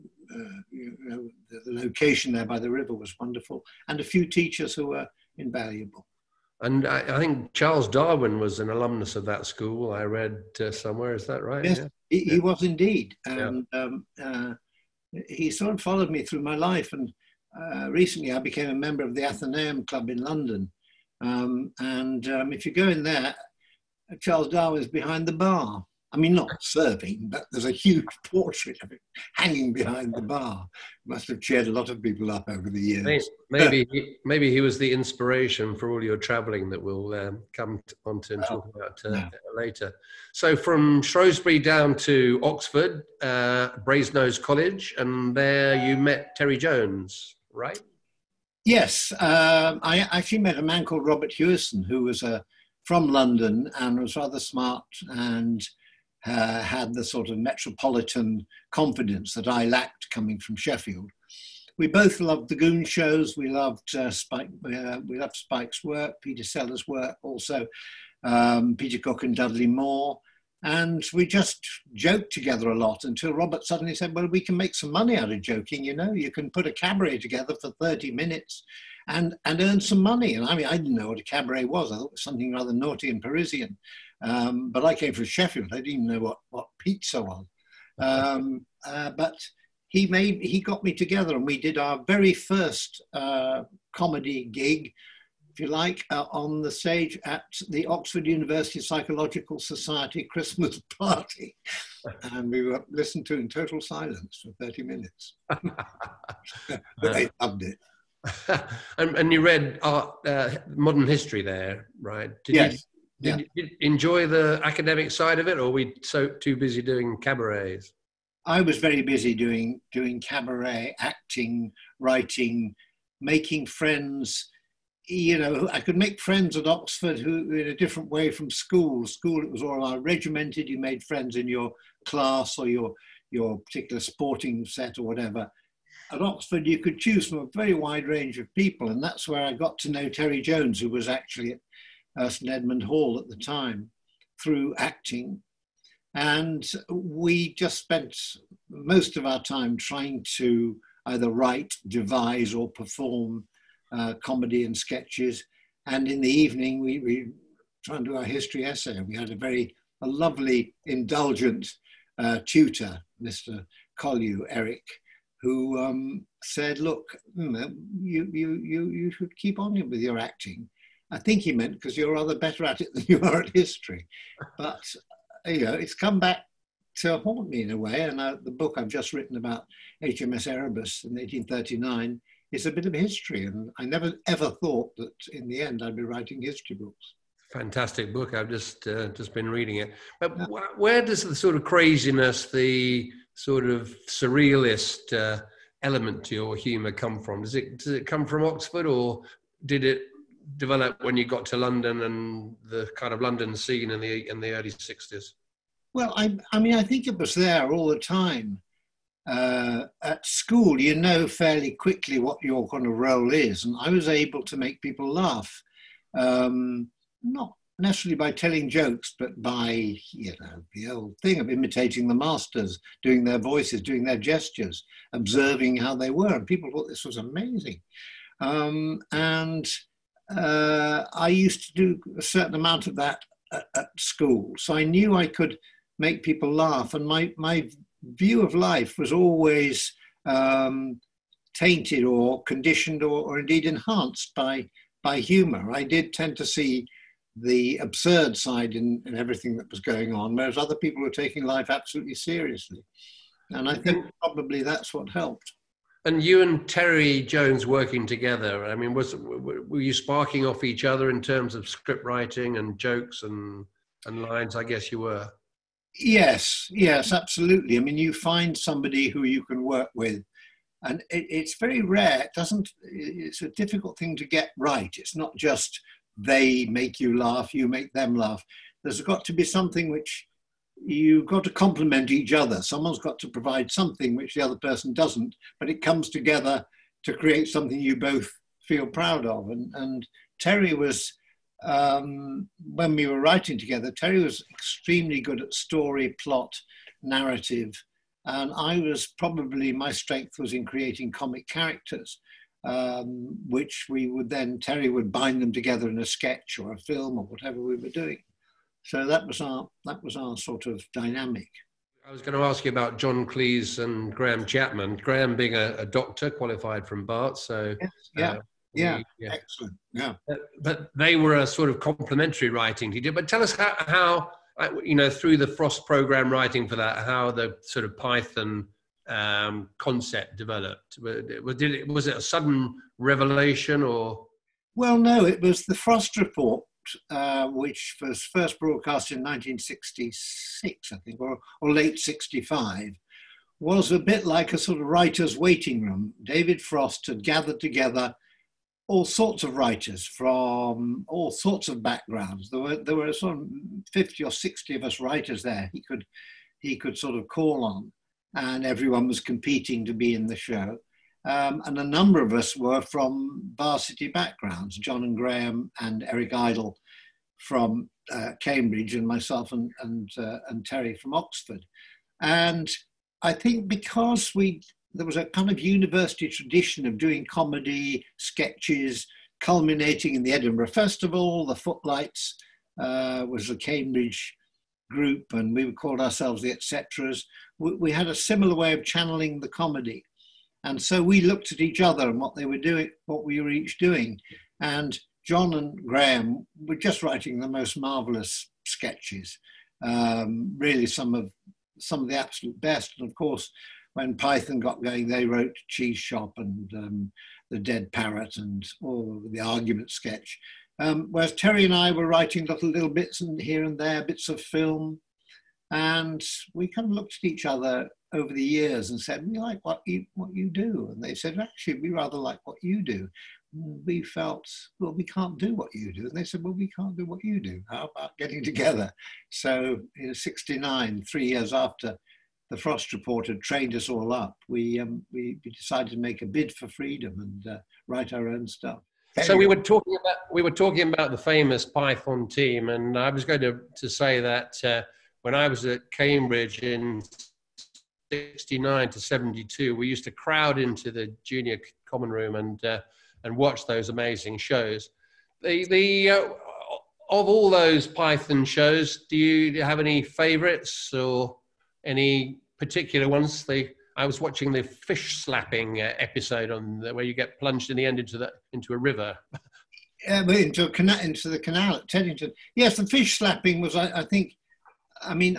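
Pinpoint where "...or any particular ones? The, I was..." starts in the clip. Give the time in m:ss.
7:40.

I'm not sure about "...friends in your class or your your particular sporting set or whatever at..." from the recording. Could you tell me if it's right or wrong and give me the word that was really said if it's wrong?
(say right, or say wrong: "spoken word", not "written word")
right.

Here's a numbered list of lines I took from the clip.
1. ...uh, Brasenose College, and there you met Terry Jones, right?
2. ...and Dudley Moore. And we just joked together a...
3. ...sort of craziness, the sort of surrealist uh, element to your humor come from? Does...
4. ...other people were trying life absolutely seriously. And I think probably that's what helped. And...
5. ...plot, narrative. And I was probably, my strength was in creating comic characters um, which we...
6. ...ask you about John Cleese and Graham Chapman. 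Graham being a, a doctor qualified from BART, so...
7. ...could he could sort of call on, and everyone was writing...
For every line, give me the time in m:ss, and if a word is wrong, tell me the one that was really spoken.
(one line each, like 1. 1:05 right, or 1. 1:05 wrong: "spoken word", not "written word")
1. 0:43 right
2. 1:09 right
3. 3:11 right
4. 4:10 wrong: "taking", not "trying"
5. 4:56 right
6. 5:12 right
7. 5:55 wrong: "competing", not "writing".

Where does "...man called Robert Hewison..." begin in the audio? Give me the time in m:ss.
0:50.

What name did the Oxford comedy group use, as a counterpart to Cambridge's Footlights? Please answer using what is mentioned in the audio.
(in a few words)
the Etceteras.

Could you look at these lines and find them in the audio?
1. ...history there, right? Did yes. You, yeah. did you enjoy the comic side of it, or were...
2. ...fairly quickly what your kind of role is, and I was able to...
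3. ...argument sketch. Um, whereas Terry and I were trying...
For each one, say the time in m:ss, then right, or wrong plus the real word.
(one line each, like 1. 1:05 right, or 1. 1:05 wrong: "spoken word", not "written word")
1. 1:51 wrong: "academic", not "comic"
2. 3:31 right
3. 6:49 wrong: "writing", not "trying".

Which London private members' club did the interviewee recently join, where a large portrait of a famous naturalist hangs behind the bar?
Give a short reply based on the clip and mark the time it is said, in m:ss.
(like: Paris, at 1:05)
Athenaeum Club, at 0:19.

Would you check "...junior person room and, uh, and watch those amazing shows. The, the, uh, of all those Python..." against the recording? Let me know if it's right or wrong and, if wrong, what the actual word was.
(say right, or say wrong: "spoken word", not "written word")
wrong: "common", not "person".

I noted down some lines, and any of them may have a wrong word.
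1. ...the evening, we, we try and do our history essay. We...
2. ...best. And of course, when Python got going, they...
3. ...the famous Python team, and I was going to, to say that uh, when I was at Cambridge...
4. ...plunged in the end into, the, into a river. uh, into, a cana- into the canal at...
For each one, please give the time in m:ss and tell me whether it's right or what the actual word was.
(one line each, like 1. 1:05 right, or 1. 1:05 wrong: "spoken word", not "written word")
1. 2:36 right
2. 6:42 right
3. 7:21 right
4. 7:47 right.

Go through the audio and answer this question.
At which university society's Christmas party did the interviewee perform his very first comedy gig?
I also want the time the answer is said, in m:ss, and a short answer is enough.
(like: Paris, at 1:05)
Oxford University Psychological Society, at 1:37.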